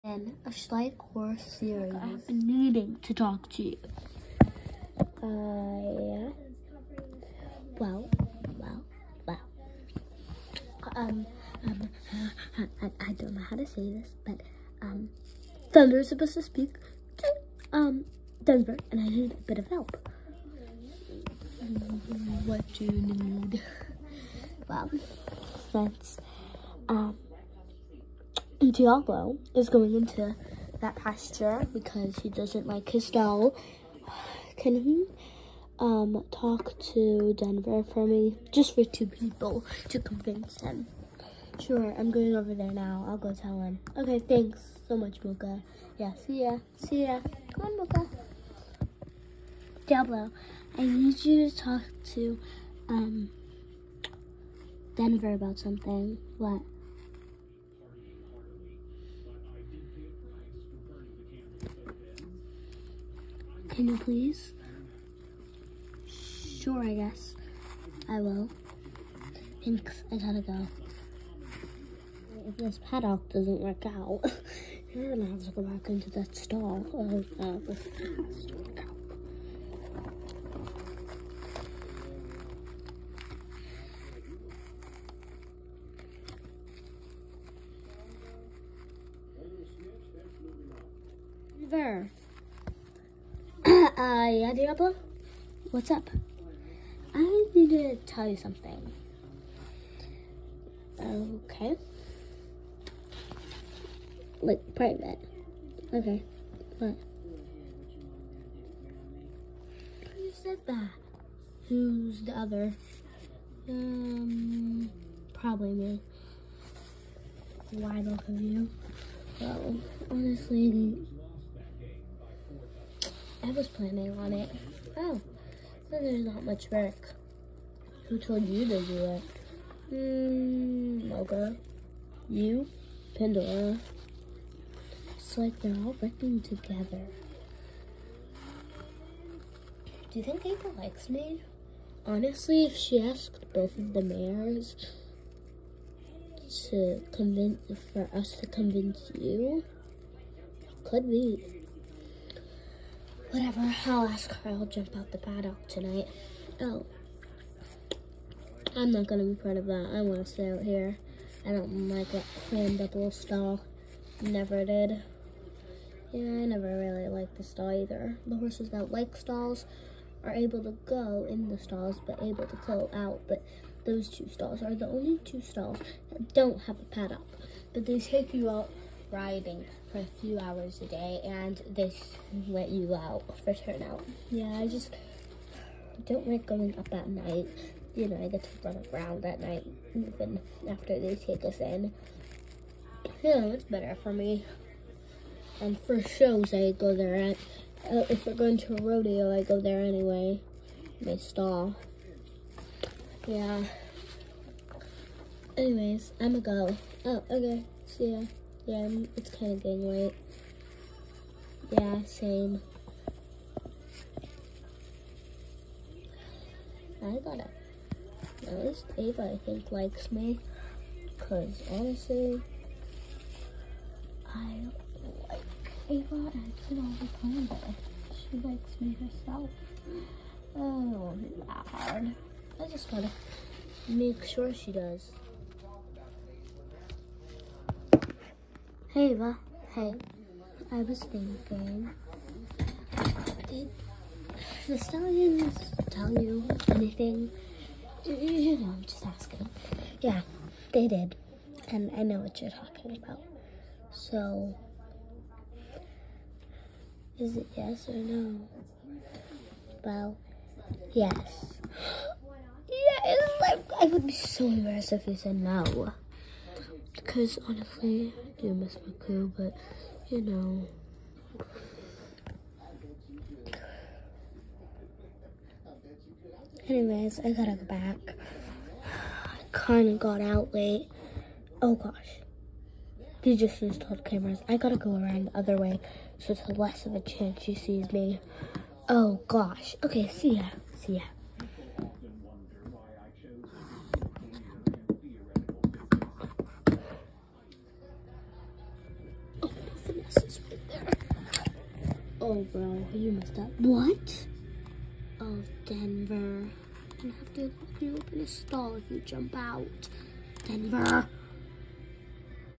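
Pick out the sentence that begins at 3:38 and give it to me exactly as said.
At least Ava, I think, likes me.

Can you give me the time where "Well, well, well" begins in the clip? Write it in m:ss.
0:07.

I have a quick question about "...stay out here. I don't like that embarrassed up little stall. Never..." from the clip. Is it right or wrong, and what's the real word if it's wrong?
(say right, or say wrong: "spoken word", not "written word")
wrong: "cramped", not "embarrassed".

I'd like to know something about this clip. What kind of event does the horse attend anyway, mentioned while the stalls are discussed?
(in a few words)
rodeo.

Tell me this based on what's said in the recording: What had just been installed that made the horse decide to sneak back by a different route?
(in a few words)
cameras.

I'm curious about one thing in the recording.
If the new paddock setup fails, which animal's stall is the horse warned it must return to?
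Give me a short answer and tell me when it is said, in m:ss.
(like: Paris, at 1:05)
the cow, at 1:17.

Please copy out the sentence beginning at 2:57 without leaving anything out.
But they take you out riding for a few hours a day and this let you out for turnout.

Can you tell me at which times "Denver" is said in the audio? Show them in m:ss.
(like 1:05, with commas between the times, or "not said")
0:18, 0:37, 0:54, 5:05, 5:10.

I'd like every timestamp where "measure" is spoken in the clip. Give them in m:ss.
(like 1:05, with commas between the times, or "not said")
not said.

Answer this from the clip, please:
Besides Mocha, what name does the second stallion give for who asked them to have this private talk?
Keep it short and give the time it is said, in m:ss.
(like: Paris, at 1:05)
Pandora, at 2:13.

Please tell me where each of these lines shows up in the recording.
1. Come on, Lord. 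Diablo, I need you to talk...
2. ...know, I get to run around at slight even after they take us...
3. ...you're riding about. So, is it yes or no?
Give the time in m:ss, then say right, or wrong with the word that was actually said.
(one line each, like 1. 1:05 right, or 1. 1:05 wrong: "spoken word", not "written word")
1. 0:47 wrong: "Mocha", not "Lord"
2. 3:08 wrong: "night", not "slight"
3. 4:12 wrong: "talking", not "riding".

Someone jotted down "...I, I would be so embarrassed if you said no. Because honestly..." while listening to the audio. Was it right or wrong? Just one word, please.
right.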